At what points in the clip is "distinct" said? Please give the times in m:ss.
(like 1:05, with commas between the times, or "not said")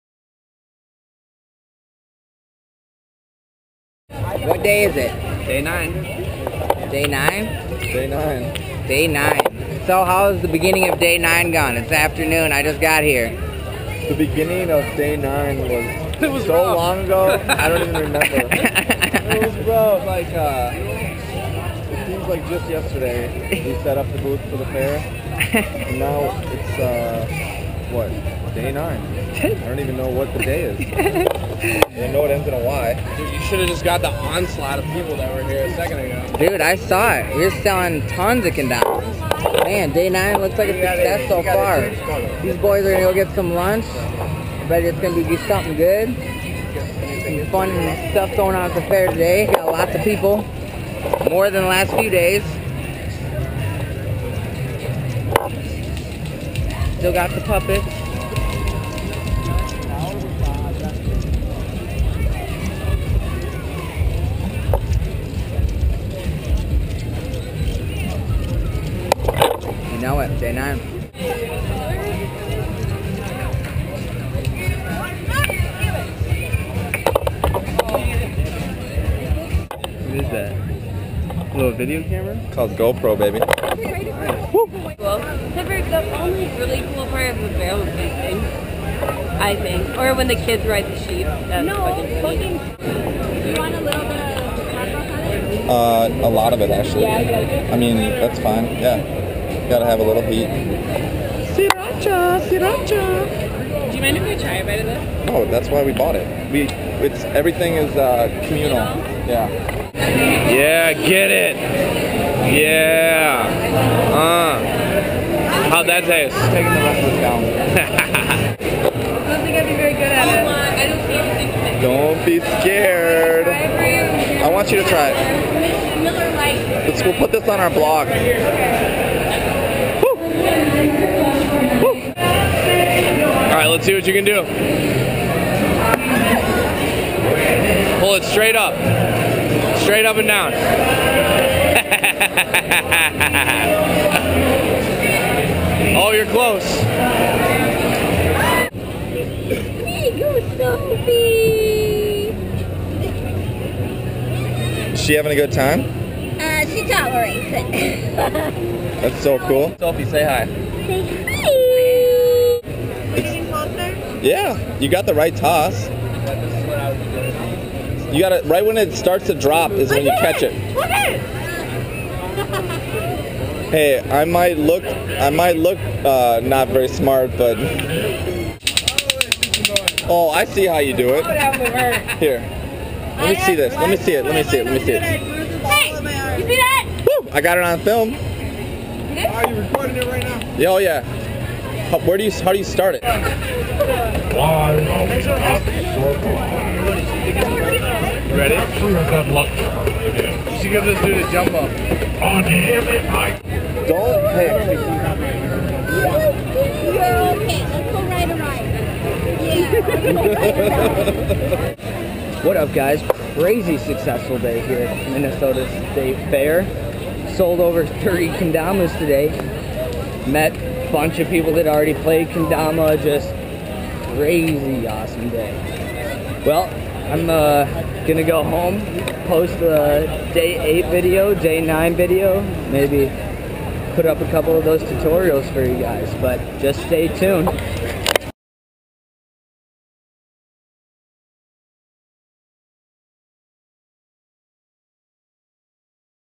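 not said.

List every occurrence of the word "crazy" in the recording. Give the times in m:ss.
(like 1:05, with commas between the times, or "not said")
3:33, 3:44.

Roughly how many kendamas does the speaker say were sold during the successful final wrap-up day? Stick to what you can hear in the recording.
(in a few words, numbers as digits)
over 30.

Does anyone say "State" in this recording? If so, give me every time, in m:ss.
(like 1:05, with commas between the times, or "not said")
3:35.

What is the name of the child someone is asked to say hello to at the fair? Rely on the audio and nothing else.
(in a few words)
Sophie.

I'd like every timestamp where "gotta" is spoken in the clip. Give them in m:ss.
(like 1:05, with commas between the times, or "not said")
1:39, 2:48.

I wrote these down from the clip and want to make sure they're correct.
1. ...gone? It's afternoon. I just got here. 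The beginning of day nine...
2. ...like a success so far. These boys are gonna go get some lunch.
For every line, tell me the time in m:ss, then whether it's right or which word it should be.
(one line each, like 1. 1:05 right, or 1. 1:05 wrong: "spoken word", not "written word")
1. 0:11 right
2. 0:40 right.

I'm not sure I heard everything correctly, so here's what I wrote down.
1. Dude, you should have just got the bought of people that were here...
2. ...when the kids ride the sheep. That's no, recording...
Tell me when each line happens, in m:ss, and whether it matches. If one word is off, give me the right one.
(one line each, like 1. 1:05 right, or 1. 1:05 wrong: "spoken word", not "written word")
1. 0:33 wrong: "onslaught", not "bought"
2. 1:30 wrong: "fucking", not "recording".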